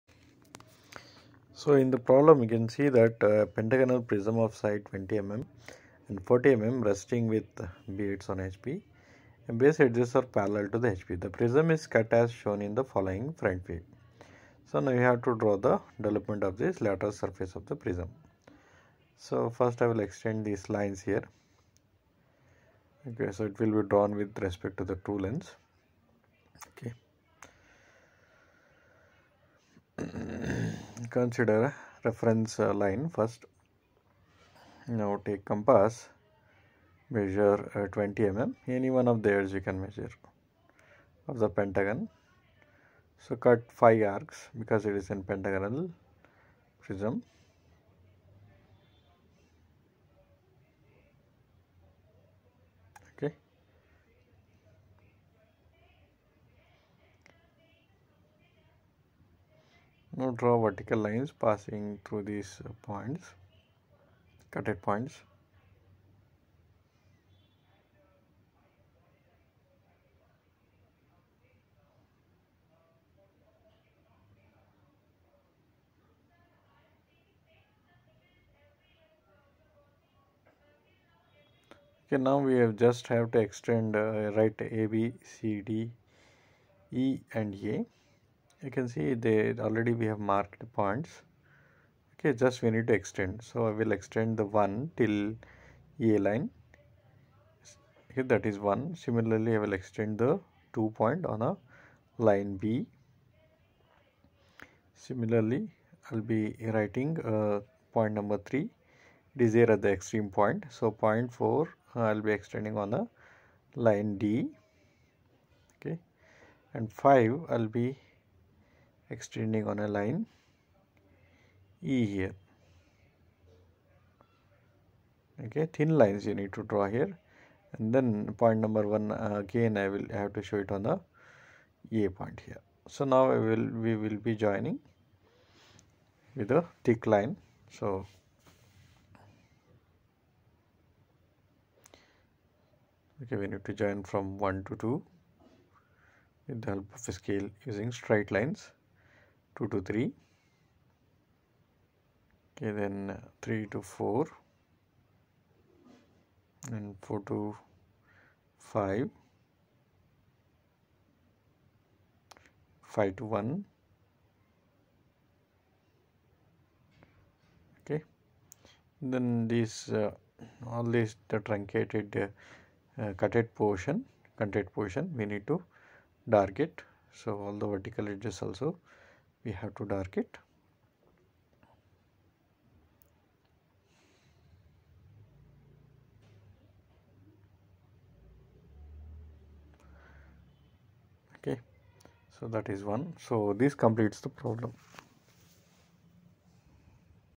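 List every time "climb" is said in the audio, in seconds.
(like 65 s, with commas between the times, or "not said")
not said.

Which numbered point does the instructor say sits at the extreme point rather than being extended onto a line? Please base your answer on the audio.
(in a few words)
3.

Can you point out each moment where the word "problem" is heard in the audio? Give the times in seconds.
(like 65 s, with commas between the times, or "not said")
1 s, 194 s.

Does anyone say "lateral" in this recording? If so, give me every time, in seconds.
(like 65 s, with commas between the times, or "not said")
16 s.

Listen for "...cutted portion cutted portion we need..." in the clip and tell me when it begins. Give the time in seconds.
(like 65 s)
173 s.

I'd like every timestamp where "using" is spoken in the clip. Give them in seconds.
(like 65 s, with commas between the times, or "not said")
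147 s.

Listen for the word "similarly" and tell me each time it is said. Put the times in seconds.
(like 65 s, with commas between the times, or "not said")
99 s, 104 s.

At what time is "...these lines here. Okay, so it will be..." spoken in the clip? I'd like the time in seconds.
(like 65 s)
20 s.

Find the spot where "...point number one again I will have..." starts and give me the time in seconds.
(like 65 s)
128 s.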